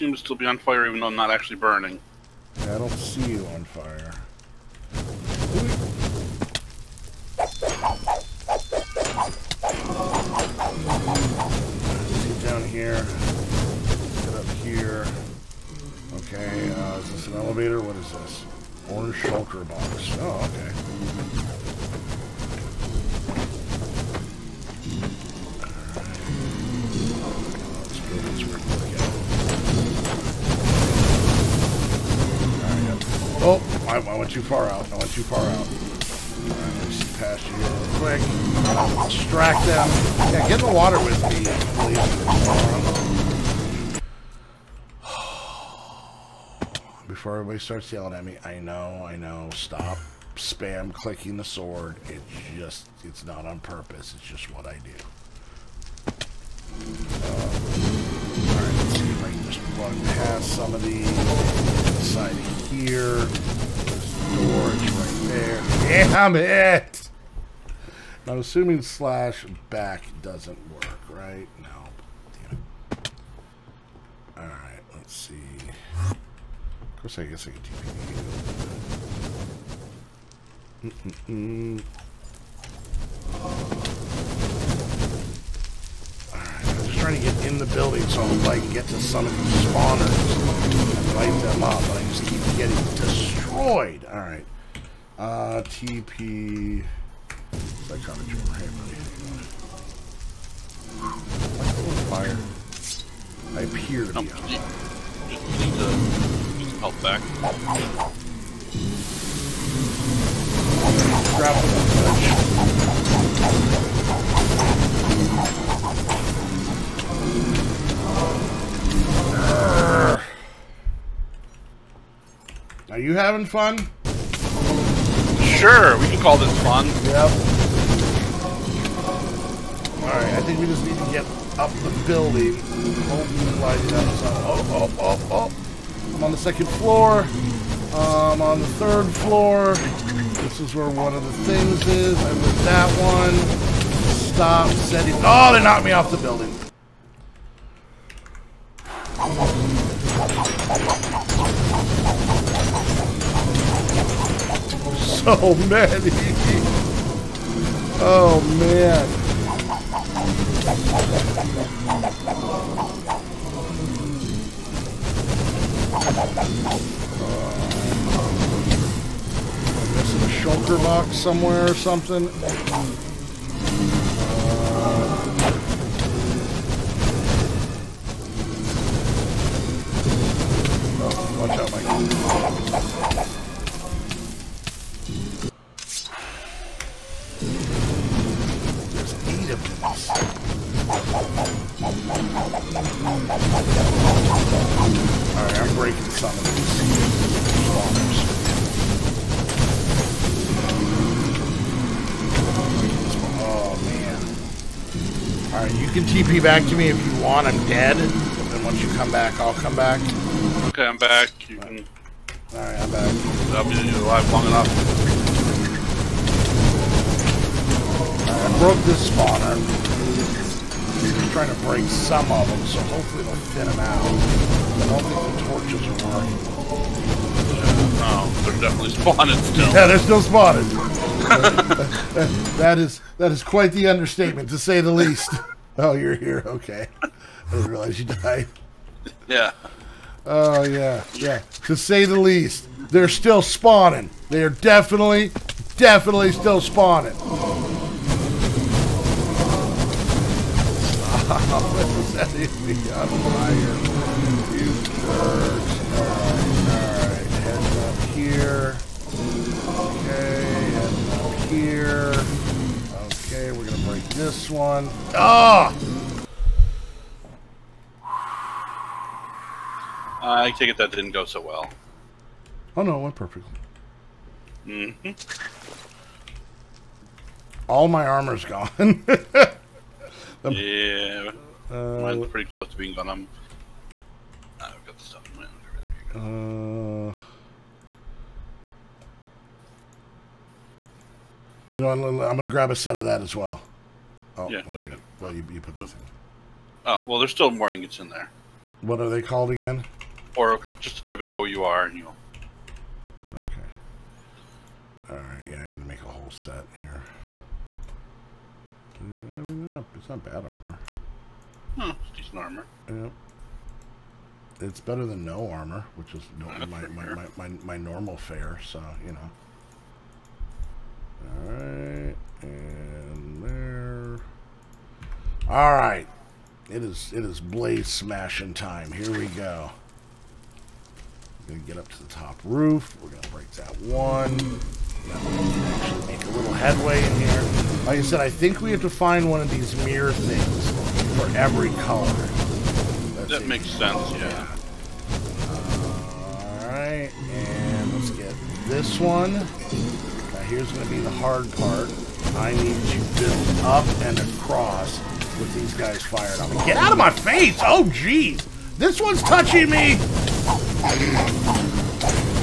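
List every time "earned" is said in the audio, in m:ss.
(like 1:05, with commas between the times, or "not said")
not said.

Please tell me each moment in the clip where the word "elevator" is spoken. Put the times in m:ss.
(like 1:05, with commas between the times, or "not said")
0:17.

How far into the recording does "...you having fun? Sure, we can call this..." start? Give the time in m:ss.
2:03.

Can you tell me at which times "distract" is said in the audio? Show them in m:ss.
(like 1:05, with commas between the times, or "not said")
0:39.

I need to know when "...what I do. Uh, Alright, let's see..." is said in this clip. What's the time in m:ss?
0:54.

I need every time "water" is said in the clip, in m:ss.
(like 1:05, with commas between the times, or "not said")
0:40.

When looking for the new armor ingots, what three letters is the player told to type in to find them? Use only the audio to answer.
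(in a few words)
OUR.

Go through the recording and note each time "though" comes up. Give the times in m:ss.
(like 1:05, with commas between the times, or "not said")
0:01.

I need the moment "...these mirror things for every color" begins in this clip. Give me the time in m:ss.
5:39.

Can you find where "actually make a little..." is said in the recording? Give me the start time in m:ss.
5:35.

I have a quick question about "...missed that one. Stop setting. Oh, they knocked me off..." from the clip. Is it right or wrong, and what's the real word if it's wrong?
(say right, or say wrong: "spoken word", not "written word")
right.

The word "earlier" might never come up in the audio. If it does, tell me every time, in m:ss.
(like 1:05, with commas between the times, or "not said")
not said.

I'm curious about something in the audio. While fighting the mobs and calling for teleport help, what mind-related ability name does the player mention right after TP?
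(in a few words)
Psychometry.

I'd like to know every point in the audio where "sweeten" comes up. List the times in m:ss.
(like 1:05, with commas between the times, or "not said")
not said.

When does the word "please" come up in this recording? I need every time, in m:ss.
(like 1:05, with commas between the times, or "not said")
0:43.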